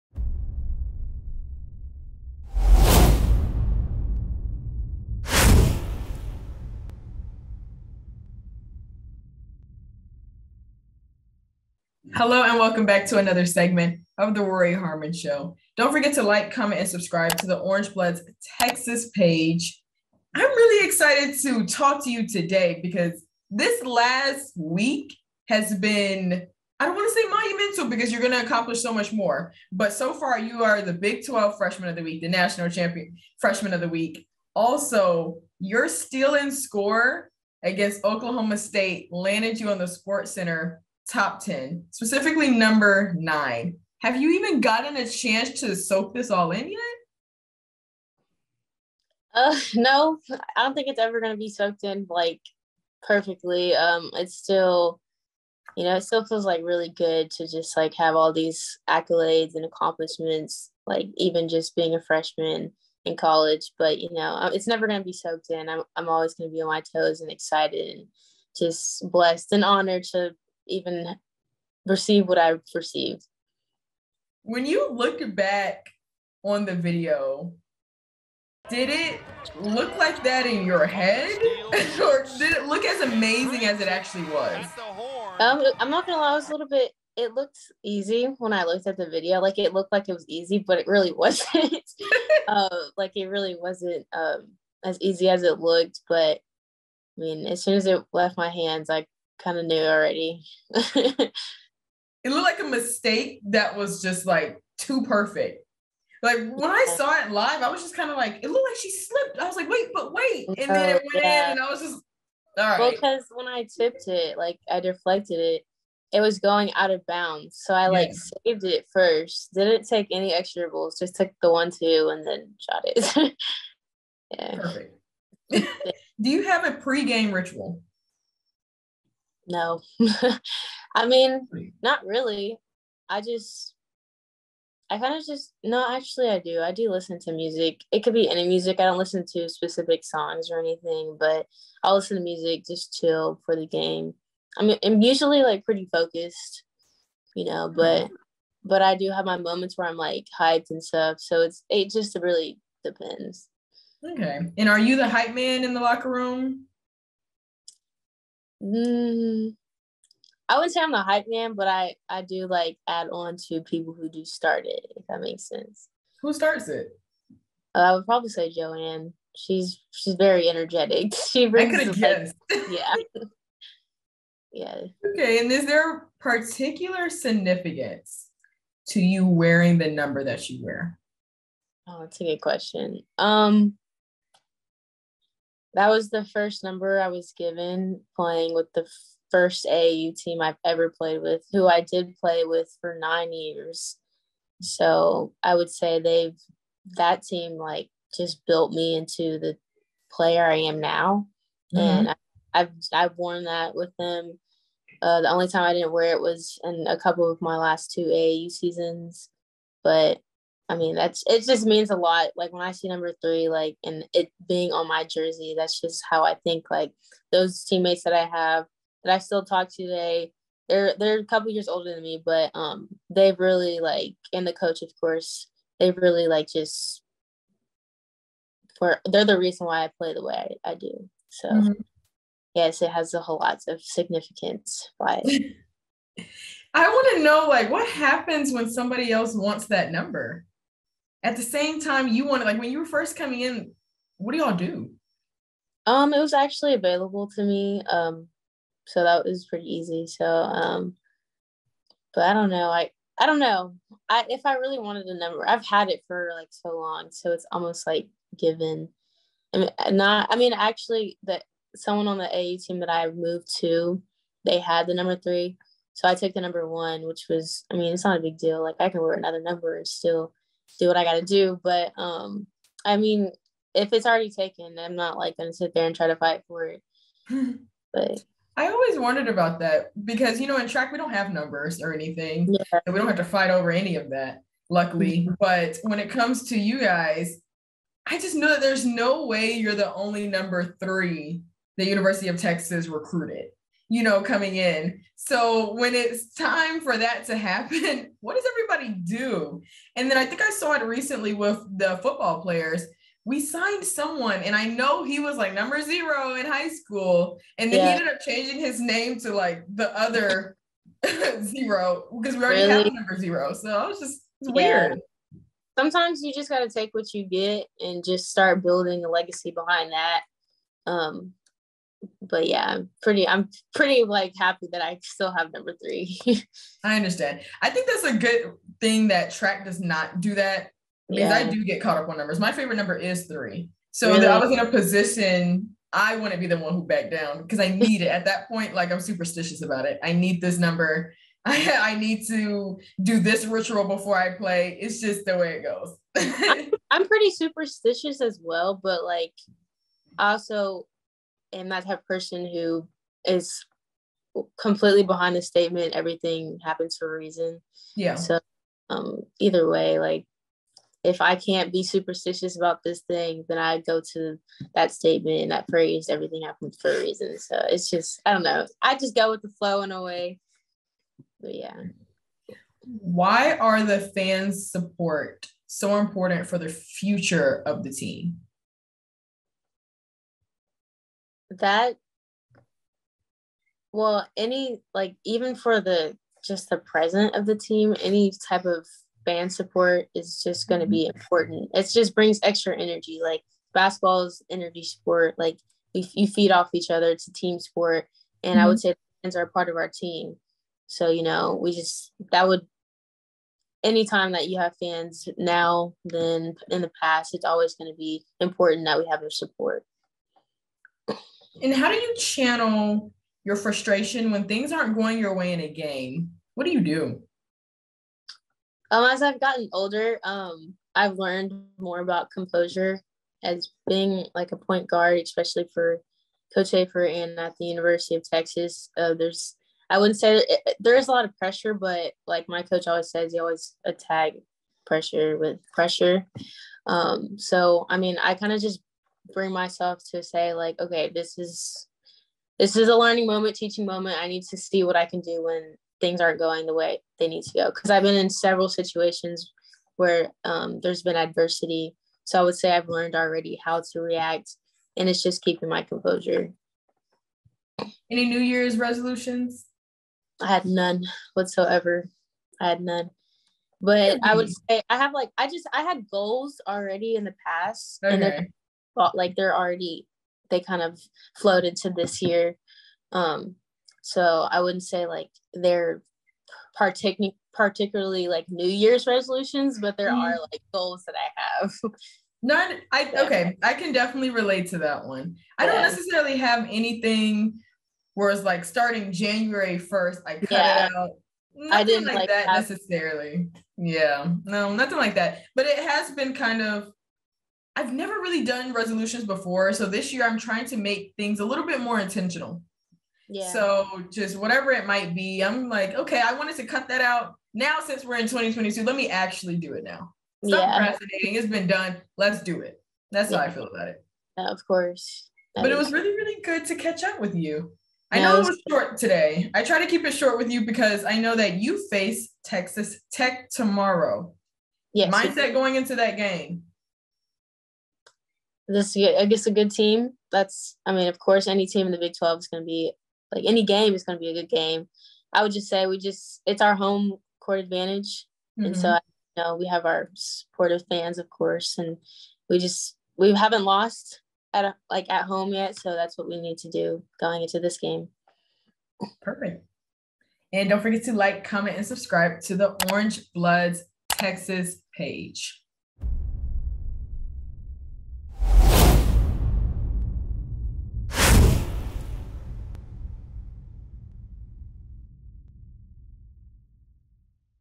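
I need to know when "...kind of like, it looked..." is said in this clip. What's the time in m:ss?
1:47.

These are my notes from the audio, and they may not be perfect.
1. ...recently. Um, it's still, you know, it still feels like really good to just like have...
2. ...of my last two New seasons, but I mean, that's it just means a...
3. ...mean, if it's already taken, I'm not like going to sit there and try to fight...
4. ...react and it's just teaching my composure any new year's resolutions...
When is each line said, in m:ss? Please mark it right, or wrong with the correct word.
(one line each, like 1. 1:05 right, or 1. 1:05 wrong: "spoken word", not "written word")
1. 0:53 wrong: "perfectly", not "recently"
2. 3:27 wrong: "AAU", not "New"
3. 4:32 right
4. 7:33 wrong: "keeping", not "teaching".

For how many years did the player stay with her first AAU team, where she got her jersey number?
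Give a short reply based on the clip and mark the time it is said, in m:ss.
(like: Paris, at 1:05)
9 years, at 3:12.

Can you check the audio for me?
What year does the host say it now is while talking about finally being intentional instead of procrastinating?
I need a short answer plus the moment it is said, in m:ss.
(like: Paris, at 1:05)
2022, at 8:28.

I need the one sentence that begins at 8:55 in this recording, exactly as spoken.
I would just say we just it's our home court advantage, mm-hmm.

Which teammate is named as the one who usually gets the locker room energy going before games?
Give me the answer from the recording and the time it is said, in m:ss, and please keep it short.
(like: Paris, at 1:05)
Joanne, at 2:48.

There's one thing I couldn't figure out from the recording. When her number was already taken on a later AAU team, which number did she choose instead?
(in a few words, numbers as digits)
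1.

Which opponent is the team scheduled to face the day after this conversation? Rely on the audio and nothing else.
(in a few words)
Texas Tech.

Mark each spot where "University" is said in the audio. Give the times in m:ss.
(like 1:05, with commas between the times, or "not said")
4:51, 7:07.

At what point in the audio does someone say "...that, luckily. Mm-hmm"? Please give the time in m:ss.
4:44.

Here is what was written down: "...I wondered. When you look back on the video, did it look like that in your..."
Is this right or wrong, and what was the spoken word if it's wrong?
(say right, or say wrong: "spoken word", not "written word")
wrong: "received", not "wondered".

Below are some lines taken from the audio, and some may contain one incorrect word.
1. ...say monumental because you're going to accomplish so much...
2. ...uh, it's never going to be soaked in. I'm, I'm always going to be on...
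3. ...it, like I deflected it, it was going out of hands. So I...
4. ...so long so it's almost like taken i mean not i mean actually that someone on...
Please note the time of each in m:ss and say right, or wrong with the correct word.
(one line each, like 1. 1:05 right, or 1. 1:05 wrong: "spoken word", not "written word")
1. 0:27 right
2. 1:04 right
3. 1:54 wrong: "bounds", not "hands"
4. 4:16 wrong: "given", not "taken".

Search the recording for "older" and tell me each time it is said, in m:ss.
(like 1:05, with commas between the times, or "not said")
3:41, 6:59.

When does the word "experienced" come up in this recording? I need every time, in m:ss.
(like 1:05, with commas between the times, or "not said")
not said.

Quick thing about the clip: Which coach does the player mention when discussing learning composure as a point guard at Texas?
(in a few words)
Coach Schaefer.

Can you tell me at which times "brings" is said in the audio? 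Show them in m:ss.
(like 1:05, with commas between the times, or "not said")
2:51, 6:32, 7:19.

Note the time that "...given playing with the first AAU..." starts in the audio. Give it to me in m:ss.
3:07.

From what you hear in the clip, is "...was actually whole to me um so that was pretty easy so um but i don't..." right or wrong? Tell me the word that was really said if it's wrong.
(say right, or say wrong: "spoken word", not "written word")
wrong: "available", not "whole".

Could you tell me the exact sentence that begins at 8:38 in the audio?
I know it was short today.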